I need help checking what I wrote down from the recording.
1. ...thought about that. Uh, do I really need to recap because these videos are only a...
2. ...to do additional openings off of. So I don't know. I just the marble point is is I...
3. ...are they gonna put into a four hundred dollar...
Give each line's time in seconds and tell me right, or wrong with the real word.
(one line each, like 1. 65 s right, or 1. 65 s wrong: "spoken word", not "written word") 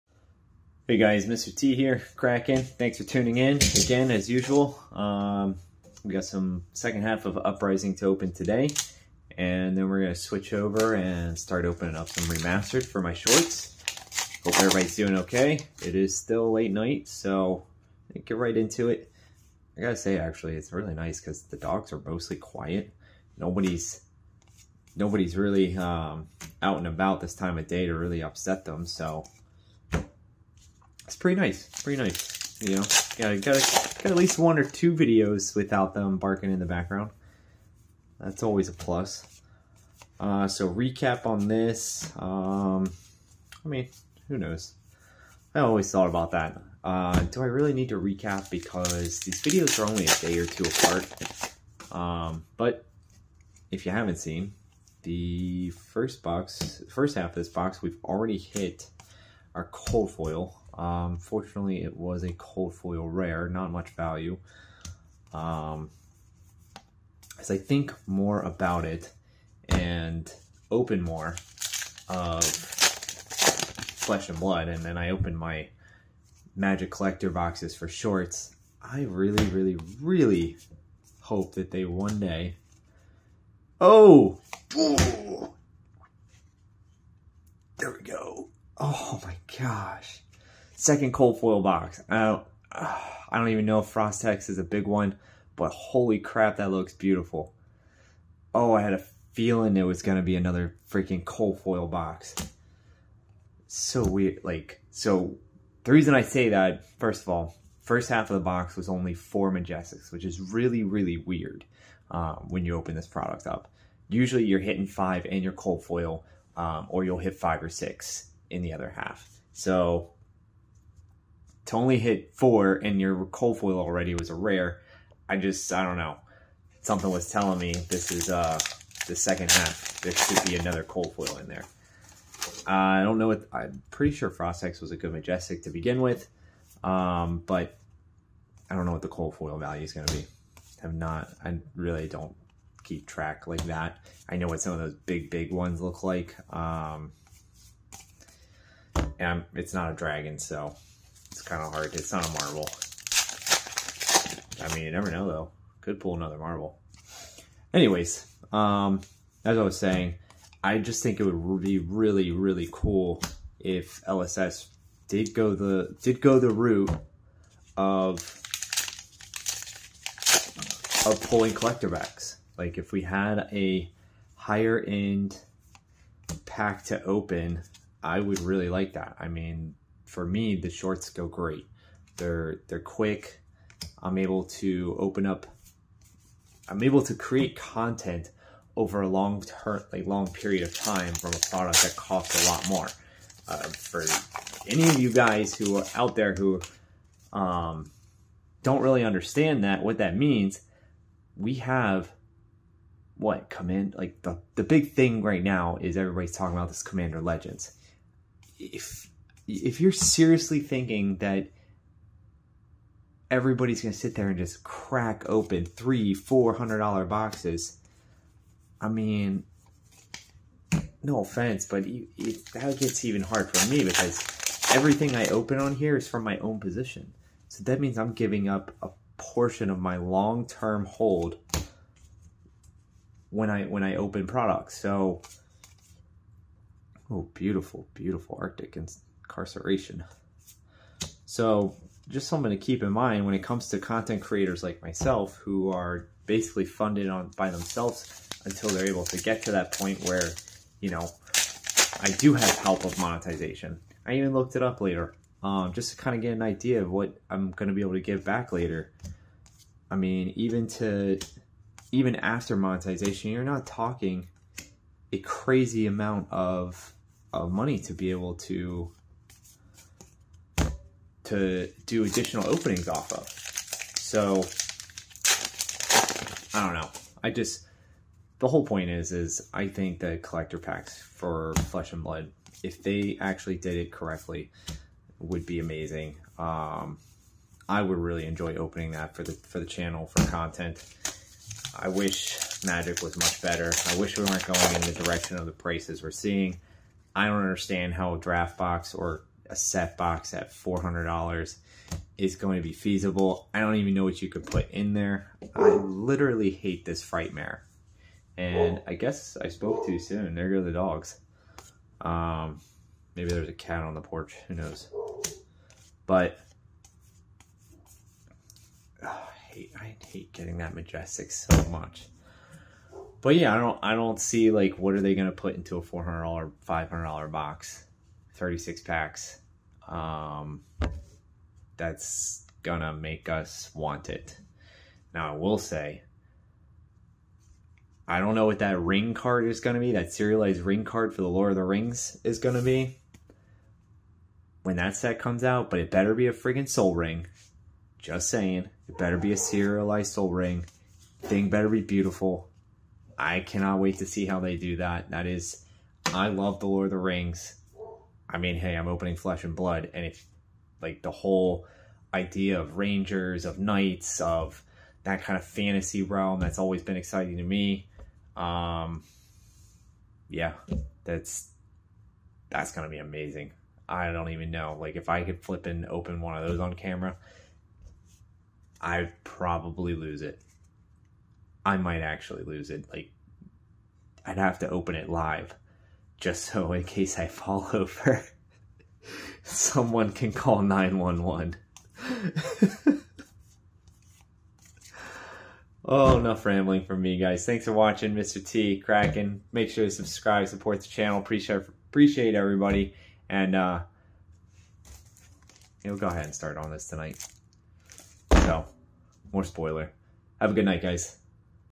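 1. 45 s right
2. 271 s wrong: "whole", not "marble"
3. 324 s right.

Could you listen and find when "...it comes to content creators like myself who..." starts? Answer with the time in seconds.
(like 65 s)
243 s.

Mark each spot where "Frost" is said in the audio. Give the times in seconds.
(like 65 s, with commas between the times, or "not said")
93 s, 134 s.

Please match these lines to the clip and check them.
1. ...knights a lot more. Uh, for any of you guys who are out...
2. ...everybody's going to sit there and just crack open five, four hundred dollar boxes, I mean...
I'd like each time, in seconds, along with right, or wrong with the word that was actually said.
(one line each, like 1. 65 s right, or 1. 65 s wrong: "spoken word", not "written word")
1. 191 s wrong: "costs", not "knights"
2. 213 s wrong: "three", not "five".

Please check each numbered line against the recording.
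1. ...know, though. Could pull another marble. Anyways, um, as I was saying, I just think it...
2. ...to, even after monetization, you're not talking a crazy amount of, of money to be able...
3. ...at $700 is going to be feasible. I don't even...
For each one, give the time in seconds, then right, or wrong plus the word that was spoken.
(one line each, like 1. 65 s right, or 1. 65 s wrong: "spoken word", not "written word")
1. 155 s right
2. 260 s right
3. 300 s wrong: "400", not "700".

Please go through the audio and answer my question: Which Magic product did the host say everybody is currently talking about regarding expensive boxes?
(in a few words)
Commander Legends.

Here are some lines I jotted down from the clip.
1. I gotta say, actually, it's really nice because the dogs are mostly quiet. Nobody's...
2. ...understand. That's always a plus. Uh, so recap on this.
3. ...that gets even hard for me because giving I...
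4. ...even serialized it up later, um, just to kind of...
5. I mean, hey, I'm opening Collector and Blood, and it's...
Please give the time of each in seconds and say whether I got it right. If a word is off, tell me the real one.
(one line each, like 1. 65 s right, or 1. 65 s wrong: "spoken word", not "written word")
1. 19 s right
2. 36 s wrong: "background", not "understand"
3. 222 s wrong: "everything", not "giving"
4. 254 s wrong: "looked", not "serialized"
5. 358 s wrong: "Flesh", not "Collector".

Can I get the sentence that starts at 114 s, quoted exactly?
Usually you're hitting five and your cold foil, um, or you'll hit five or six in the other half.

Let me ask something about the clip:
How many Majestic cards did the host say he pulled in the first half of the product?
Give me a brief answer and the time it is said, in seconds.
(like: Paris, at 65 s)
4, at 109 s.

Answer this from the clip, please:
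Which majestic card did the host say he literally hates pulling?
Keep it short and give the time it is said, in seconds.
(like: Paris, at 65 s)
Frightmare, at 307 s.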